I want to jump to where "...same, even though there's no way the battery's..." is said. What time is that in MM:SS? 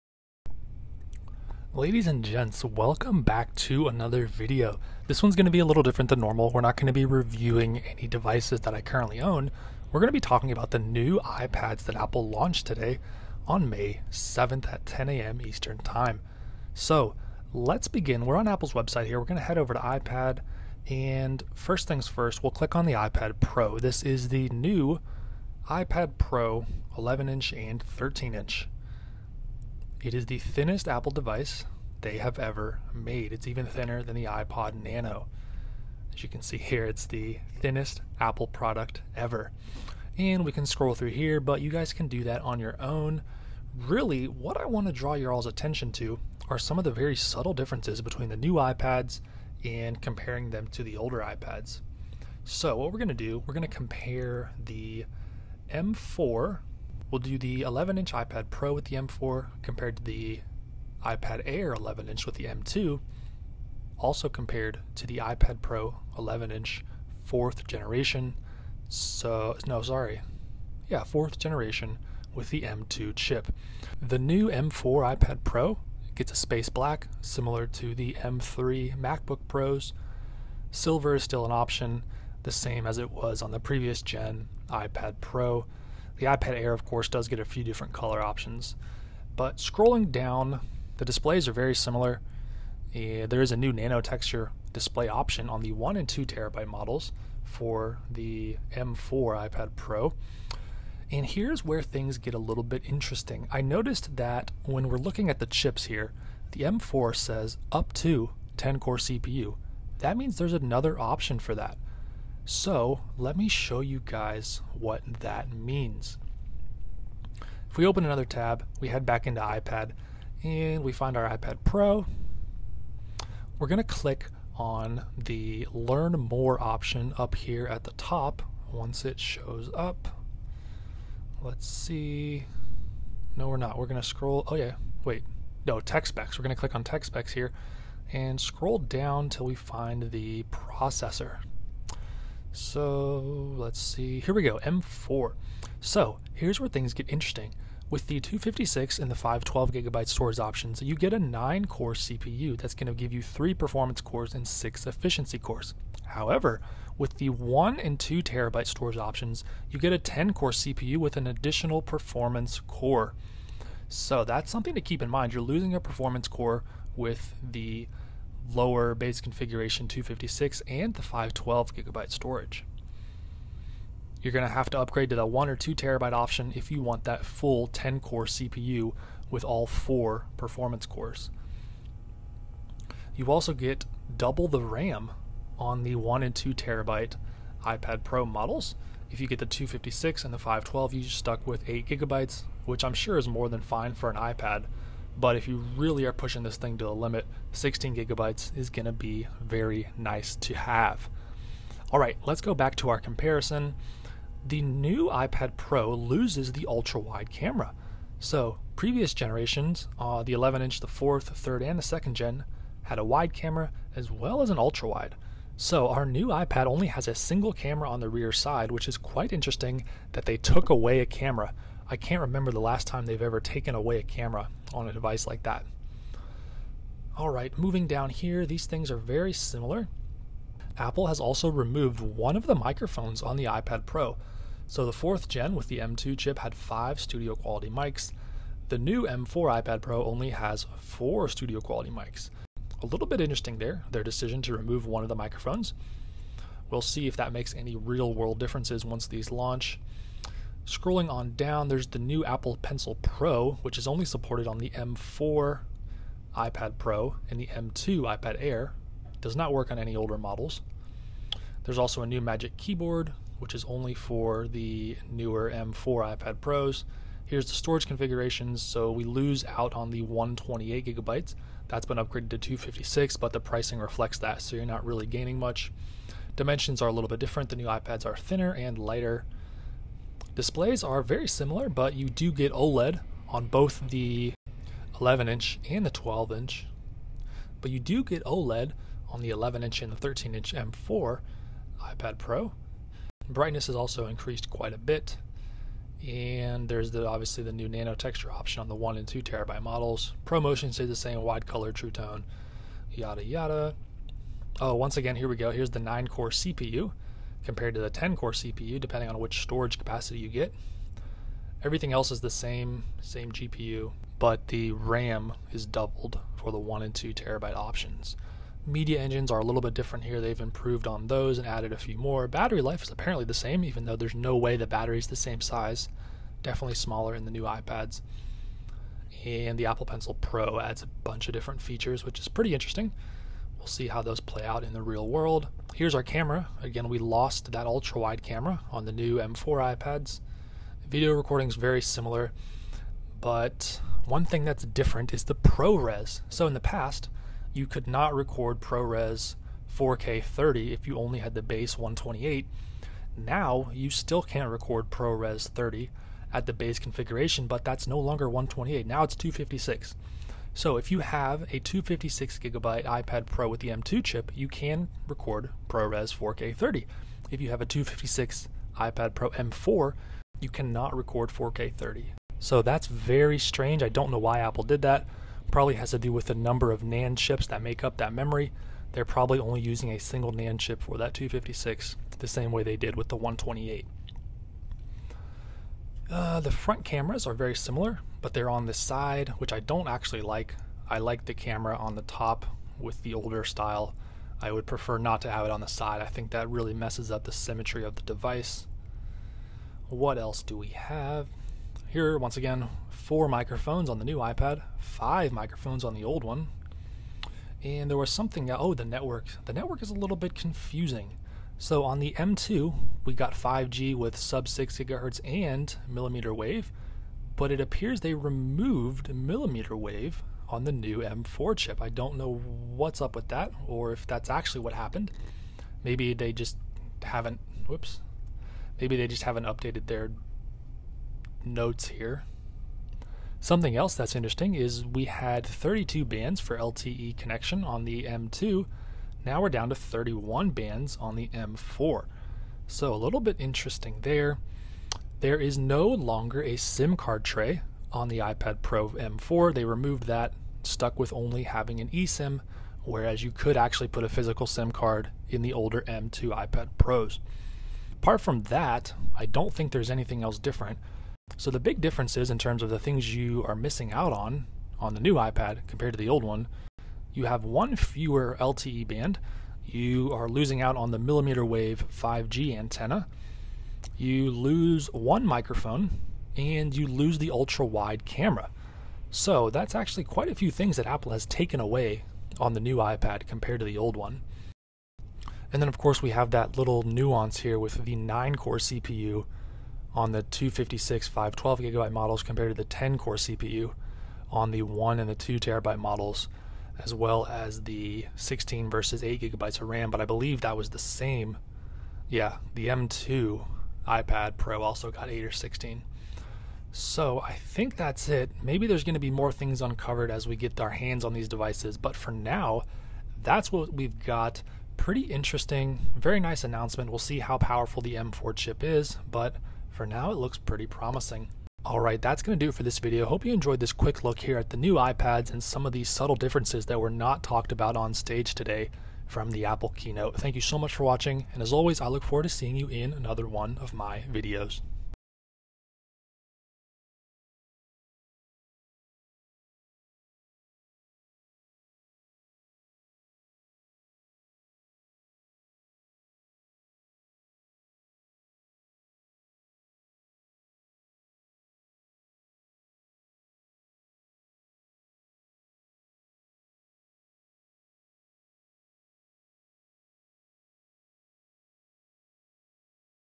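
05:23.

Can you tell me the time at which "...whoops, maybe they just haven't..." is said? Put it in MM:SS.
07:07.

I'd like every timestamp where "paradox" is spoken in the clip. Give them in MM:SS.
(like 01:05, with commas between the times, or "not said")
not said.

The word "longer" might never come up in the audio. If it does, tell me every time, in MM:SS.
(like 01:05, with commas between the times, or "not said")
05:57, 07:25.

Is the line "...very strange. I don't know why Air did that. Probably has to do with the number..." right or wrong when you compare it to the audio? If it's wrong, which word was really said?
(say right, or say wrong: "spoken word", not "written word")
wrong: "Apple", not "Air".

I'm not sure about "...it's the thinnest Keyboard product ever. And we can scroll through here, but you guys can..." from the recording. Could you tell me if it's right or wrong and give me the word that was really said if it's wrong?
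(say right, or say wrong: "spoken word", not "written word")
wrong: "Apple", not "Keyboard".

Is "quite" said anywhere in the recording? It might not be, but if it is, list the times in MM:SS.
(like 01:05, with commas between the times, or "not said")
03:38, 04:54, 08:00.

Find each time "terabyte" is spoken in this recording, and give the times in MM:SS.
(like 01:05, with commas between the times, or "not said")
01:36, 02:38, 02:55, 03:06, 04:59, 05:17, 08:15.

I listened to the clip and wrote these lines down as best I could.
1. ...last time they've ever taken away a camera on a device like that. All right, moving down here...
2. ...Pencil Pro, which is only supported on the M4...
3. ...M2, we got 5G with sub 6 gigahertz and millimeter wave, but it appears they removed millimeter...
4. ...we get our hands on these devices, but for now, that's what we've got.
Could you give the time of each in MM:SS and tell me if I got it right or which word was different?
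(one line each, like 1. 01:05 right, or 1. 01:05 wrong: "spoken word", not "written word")
1. 03:42 right
2. 04:12 right
3. 06:52 right
4. 08:30 right.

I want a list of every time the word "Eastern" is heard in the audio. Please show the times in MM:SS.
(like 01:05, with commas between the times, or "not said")
00:15.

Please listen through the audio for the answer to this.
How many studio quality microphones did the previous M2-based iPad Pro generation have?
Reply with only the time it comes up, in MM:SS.
03:56.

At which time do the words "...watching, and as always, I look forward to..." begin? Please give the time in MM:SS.
08:50.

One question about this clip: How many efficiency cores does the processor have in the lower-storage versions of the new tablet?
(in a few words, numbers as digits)
6.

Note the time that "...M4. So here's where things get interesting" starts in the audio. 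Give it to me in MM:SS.
02:24.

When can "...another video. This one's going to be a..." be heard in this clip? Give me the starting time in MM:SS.
00:03.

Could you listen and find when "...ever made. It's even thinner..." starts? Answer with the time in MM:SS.
00:32.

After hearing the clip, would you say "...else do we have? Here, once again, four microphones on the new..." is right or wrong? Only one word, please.
right.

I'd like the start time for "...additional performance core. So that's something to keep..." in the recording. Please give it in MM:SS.
02:41.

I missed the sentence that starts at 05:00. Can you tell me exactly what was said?
ProMotion stays the same wide color, true tone, yada yada.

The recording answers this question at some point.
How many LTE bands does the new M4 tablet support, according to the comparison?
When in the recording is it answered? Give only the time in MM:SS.
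07:19.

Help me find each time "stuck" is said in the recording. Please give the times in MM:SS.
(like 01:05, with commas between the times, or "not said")
03:11, 07:30.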